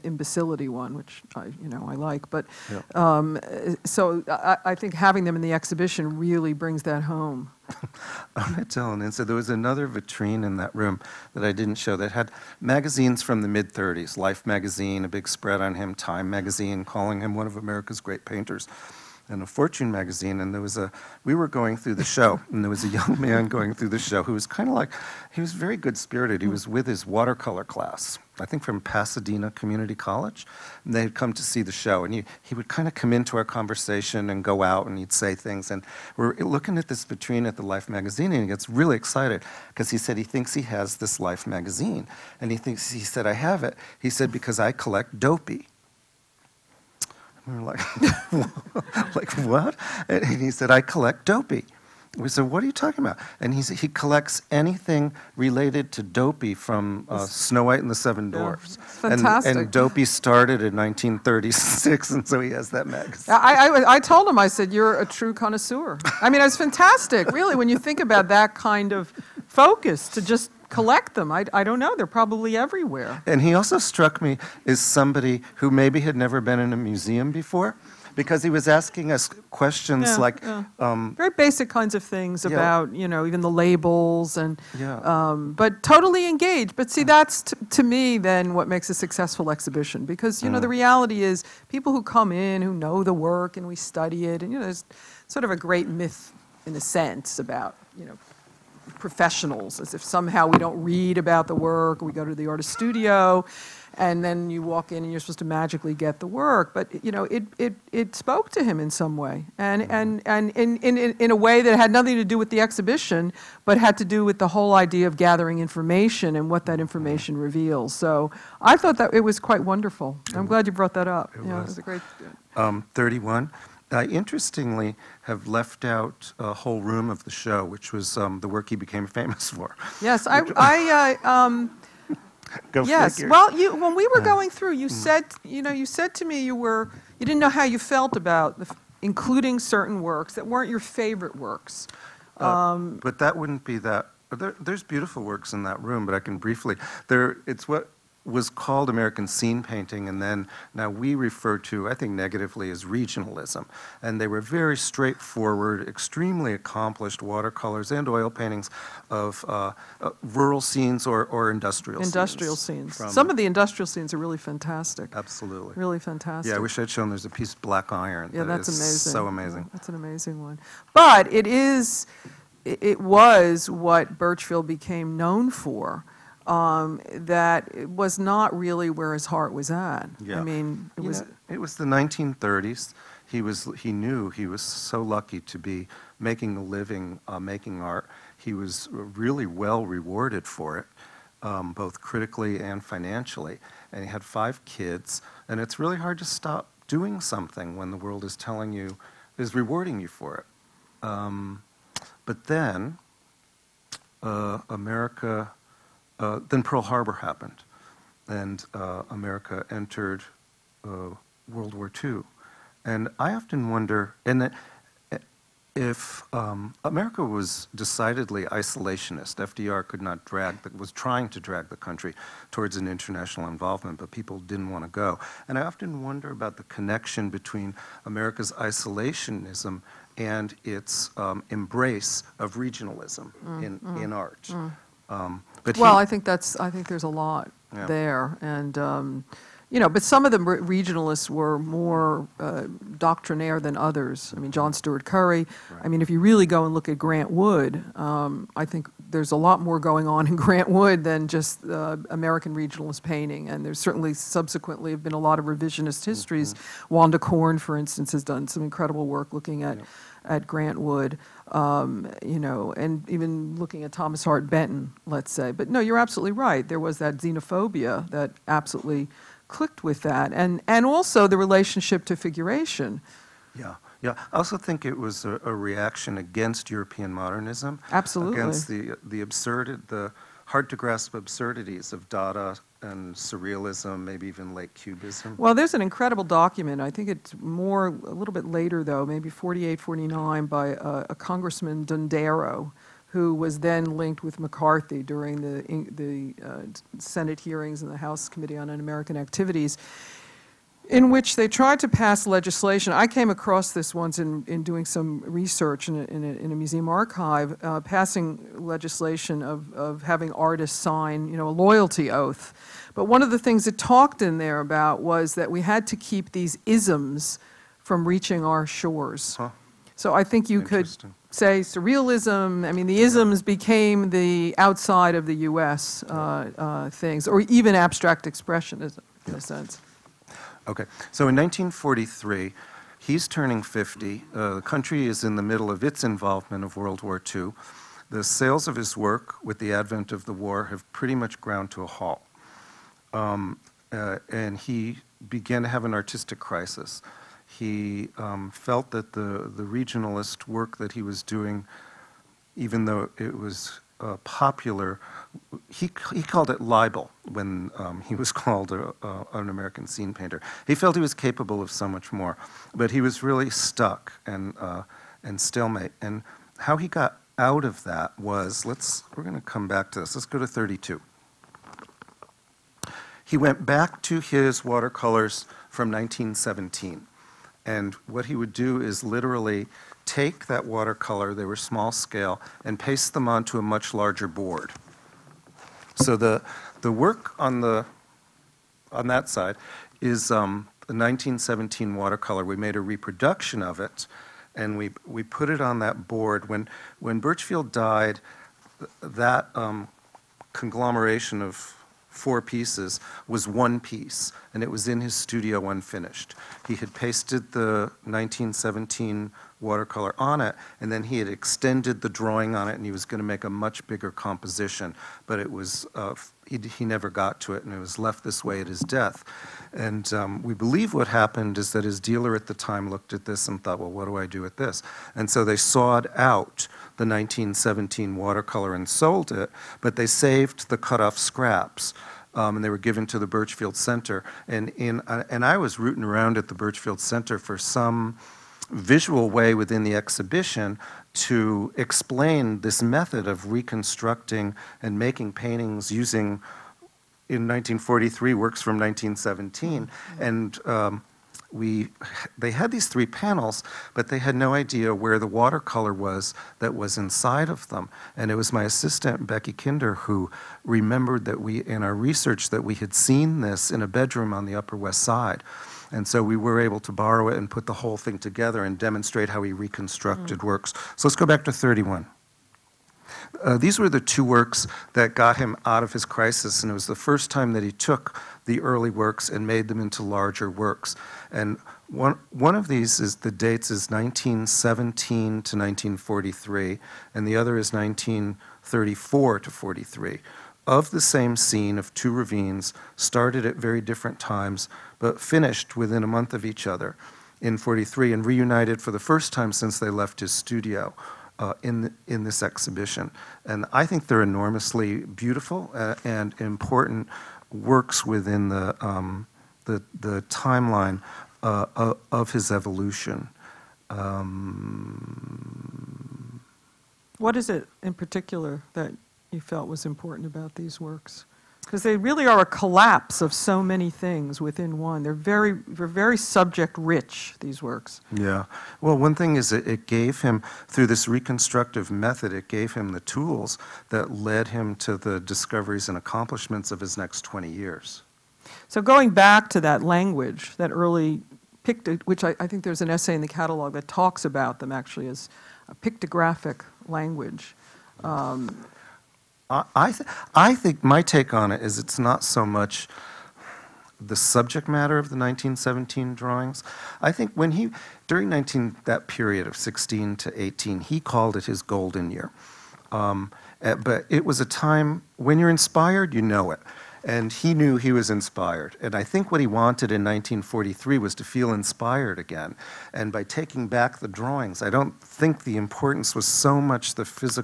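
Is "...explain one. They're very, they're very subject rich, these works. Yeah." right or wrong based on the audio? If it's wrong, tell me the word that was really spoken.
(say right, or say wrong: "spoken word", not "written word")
wrong: "within", not "explain".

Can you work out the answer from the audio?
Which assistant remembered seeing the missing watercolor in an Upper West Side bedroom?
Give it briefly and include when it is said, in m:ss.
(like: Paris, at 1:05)
Becky Kinder, at 7:39.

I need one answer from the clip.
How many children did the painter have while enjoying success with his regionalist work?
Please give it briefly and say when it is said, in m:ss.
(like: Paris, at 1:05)
5, at 3:14.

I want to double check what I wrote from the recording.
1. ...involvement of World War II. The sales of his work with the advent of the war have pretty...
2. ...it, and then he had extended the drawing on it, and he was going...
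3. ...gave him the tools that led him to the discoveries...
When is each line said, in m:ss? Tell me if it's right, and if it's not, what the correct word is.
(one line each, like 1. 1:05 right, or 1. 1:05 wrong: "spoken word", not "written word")
1. 5:36 right
2. 6:50 right
3. 8:52 right.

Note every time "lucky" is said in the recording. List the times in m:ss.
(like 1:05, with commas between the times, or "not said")
3:05.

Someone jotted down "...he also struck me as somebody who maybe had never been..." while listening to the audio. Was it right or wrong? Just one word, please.
right.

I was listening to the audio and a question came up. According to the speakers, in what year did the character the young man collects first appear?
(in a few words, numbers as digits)
1936.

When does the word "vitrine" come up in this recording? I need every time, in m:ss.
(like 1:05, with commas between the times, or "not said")
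0:09, 0:37.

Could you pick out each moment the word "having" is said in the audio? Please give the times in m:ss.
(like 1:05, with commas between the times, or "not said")
0:04, 5:10.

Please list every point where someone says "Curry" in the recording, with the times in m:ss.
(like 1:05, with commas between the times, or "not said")
4:05.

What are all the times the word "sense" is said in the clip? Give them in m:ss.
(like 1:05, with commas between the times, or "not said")
1:36, 5:29.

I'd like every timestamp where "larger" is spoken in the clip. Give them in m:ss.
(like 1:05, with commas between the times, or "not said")
6:23, 8:00.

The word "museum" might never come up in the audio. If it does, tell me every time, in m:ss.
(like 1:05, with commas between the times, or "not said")
1:16, 5:06.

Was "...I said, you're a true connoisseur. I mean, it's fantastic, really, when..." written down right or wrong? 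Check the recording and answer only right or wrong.
right.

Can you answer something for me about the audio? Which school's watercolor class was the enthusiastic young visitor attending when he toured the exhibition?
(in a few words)
Pasadena Community College.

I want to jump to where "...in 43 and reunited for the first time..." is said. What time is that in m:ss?
8:17.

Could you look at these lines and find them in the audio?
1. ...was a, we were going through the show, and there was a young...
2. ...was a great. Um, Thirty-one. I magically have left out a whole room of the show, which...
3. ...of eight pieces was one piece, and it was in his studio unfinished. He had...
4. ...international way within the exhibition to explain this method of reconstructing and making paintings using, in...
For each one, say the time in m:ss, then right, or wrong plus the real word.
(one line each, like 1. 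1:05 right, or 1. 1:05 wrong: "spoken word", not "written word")
1. 0:20 right
2. 2:01 wrong: "interestingly", not "magically"
3. 6:41 wrong: "four", not "eight"
4. 7:18 wrong: "visual", not "international".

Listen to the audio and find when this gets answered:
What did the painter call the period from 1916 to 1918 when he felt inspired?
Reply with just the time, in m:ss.
9:21.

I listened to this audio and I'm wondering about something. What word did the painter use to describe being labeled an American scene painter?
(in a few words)
libel.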